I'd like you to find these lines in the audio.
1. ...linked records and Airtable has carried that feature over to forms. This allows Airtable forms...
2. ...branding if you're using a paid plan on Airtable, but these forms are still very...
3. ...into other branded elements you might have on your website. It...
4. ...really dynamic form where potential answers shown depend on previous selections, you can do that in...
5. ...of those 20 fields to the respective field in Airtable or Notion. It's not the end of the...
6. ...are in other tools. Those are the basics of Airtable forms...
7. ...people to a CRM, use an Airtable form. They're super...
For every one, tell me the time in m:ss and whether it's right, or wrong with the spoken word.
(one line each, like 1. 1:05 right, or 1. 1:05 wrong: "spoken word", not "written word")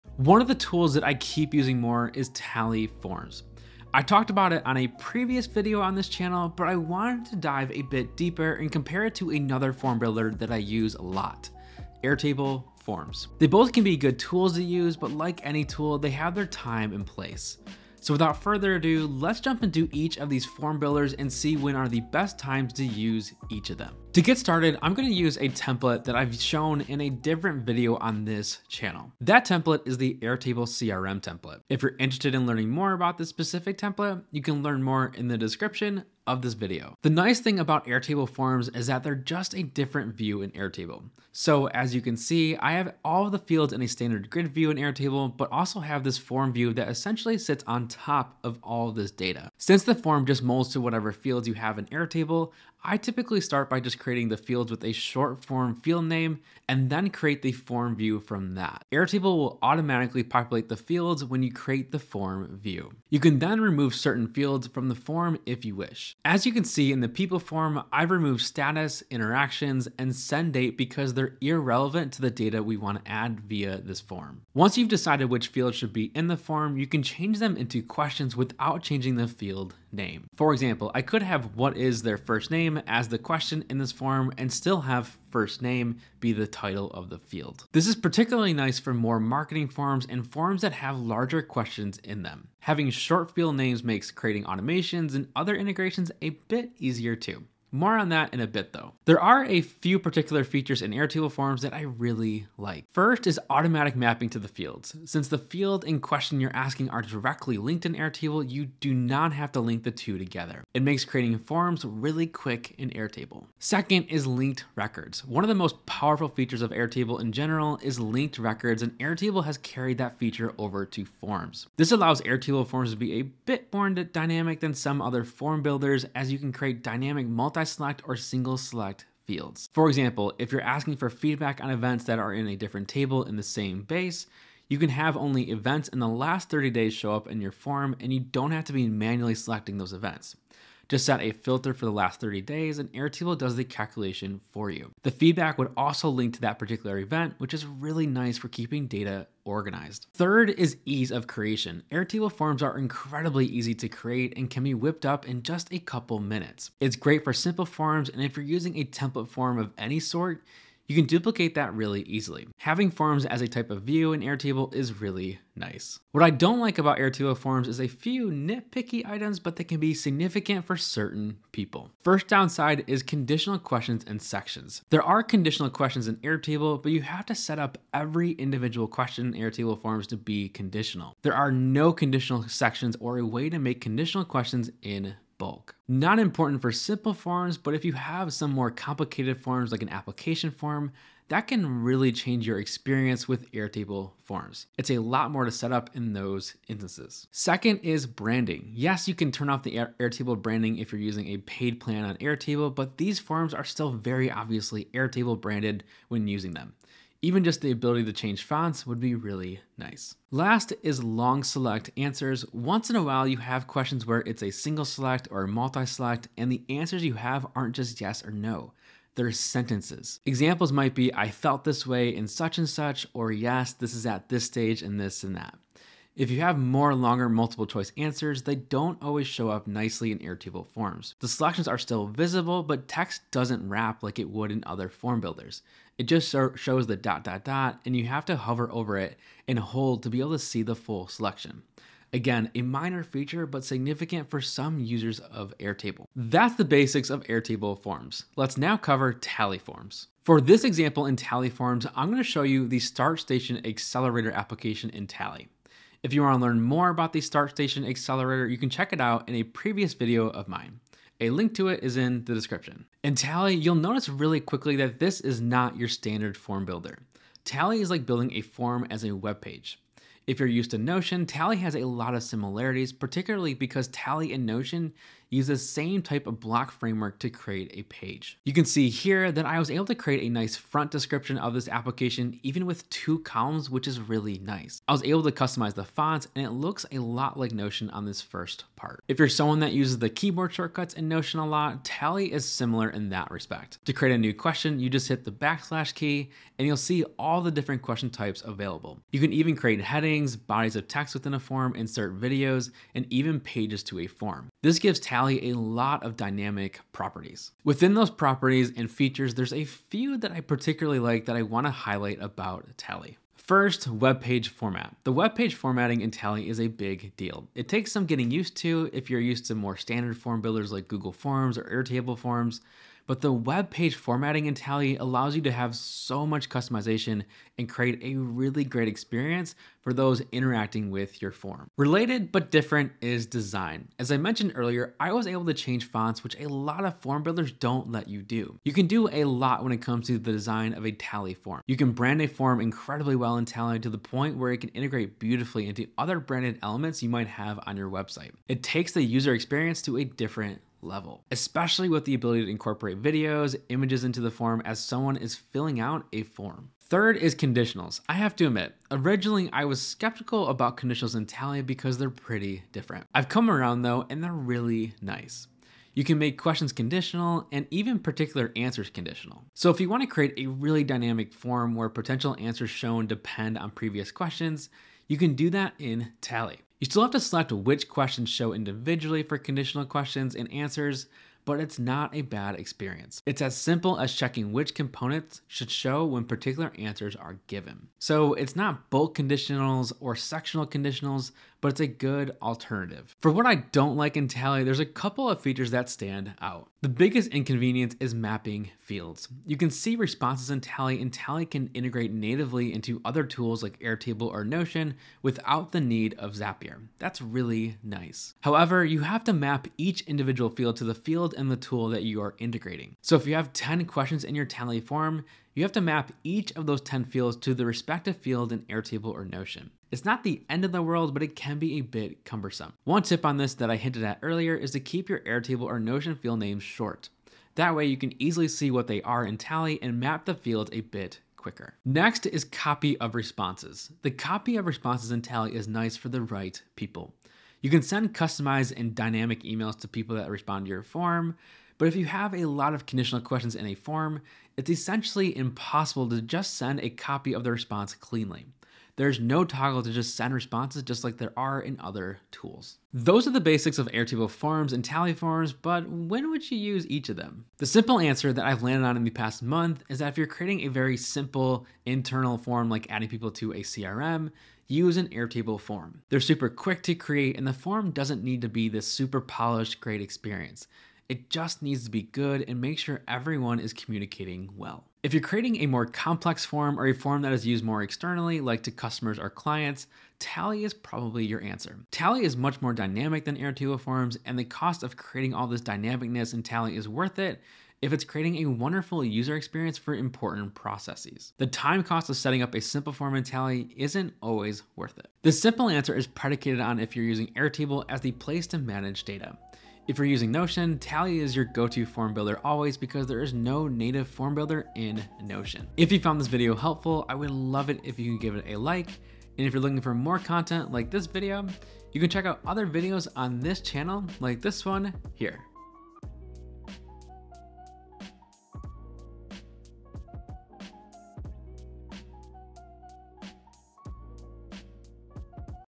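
1. 1:58 right
2. 3:20 right
3. 5:45 right
4. 6:10 wrong: "questions", not "selections"
5. 6:56 wrong: "10", not "20"
6. 7:31 right
7. 7:43 right.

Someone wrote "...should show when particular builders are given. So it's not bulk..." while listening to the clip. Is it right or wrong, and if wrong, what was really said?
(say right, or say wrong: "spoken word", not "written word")
wrong: "answers", not "builders".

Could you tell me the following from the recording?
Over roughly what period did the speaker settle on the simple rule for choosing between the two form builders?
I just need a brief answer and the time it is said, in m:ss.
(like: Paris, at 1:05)
past month, at 7:39.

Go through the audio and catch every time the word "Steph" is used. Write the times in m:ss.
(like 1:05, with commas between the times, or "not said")
not said.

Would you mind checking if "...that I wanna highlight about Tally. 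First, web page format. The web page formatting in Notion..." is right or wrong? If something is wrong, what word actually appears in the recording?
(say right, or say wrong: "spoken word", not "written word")
wrong: "Tally", not "Notion".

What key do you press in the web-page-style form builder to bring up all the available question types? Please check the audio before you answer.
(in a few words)
backslash.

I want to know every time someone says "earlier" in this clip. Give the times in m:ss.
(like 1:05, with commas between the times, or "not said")
5:34, 7:04.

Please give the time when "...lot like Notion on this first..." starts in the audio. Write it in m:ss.
4:46.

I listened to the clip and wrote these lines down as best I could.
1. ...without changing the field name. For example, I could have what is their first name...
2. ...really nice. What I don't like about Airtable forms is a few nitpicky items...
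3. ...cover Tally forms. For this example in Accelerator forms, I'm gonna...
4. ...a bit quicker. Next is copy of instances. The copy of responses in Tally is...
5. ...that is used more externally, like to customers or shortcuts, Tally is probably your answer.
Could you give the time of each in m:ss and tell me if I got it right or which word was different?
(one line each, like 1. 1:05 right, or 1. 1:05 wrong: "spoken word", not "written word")
1. 1:18 right
2. 2:44 right
3. 4:08 wrong: "Tally", not "Accelerator"
4. 7:10 wrong: "responses", not "instances"
5. 7:57 wrong: "clients", not "shortcuts".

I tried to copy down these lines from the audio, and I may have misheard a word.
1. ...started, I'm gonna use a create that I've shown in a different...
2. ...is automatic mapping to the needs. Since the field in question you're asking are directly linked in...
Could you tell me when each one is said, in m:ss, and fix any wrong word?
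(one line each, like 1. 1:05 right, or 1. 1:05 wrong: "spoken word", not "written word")
1. 0:24 wrong: "template", not "create"
2. 1:43 wrong: "fields", not "needs".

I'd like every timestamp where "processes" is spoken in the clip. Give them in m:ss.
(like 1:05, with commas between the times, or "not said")
8:10.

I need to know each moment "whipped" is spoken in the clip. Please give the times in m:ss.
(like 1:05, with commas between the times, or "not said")
2:34.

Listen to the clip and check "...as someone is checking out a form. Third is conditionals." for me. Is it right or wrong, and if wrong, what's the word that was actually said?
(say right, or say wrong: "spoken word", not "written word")
wrong: "filling", not "checking".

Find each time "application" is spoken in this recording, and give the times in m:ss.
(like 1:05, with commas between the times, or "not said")
3:09, 4:14, 4:41.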